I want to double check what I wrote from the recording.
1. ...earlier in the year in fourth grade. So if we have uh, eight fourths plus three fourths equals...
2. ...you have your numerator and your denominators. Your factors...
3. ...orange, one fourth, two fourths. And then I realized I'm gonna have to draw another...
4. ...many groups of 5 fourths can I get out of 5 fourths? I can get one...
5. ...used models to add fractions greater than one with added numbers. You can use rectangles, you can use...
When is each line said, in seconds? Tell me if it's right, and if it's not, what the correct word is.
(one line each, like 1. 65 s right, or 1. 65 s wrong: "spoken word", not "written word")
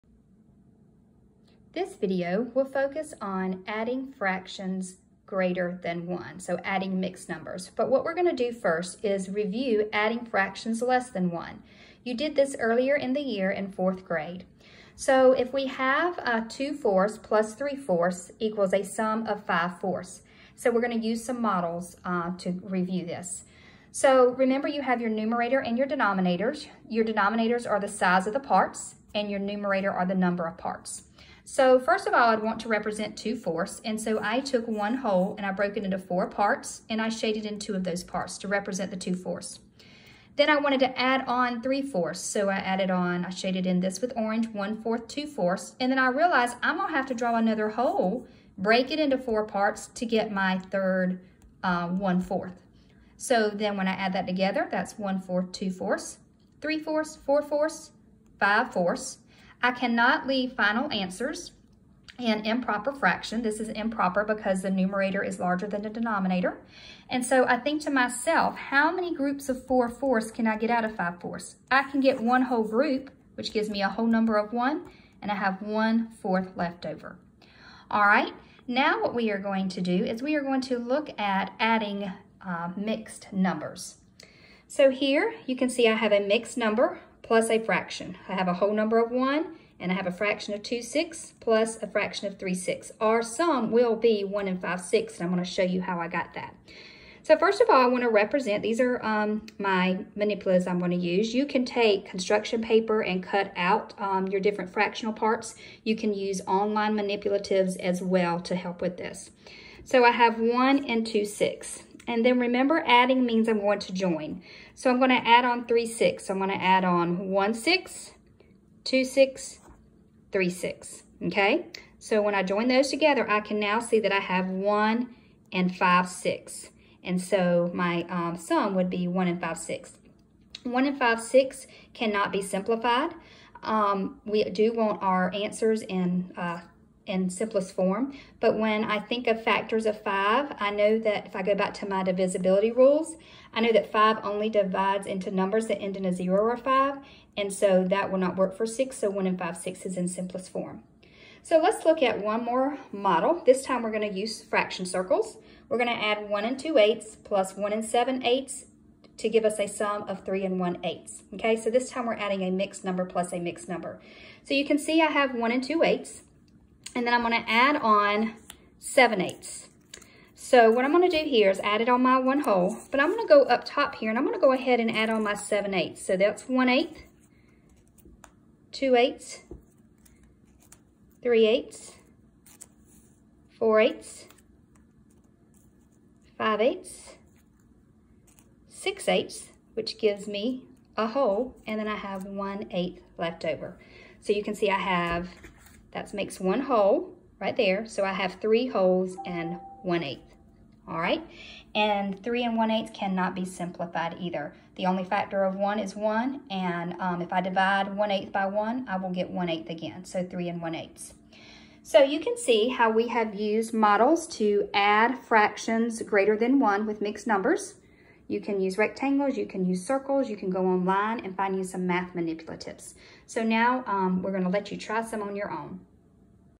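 1. 12 s wrong: "two", not "eight"
2. 24 s wrong: "denominators", not "factors"
3. 44 s right
4. 68 s wrong: "4", not "5"
5. 213 s wrong: "mixed", not "added".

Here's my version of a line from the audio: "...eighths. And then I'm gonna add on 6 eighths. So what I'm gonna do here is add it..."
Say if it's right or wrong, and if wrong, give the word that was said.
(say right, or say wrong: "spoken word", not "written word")
wrong: "7", not "6".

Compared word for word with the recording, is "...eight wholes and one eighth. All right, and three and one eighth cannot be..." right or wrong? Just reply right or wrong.
wrong.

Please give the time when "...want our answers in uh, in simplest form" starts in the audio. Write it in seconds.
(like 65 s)
134 s.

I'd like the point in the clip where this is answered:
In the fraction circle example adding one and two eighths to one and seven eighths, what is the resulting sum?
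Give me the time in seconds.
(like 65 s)
160 s.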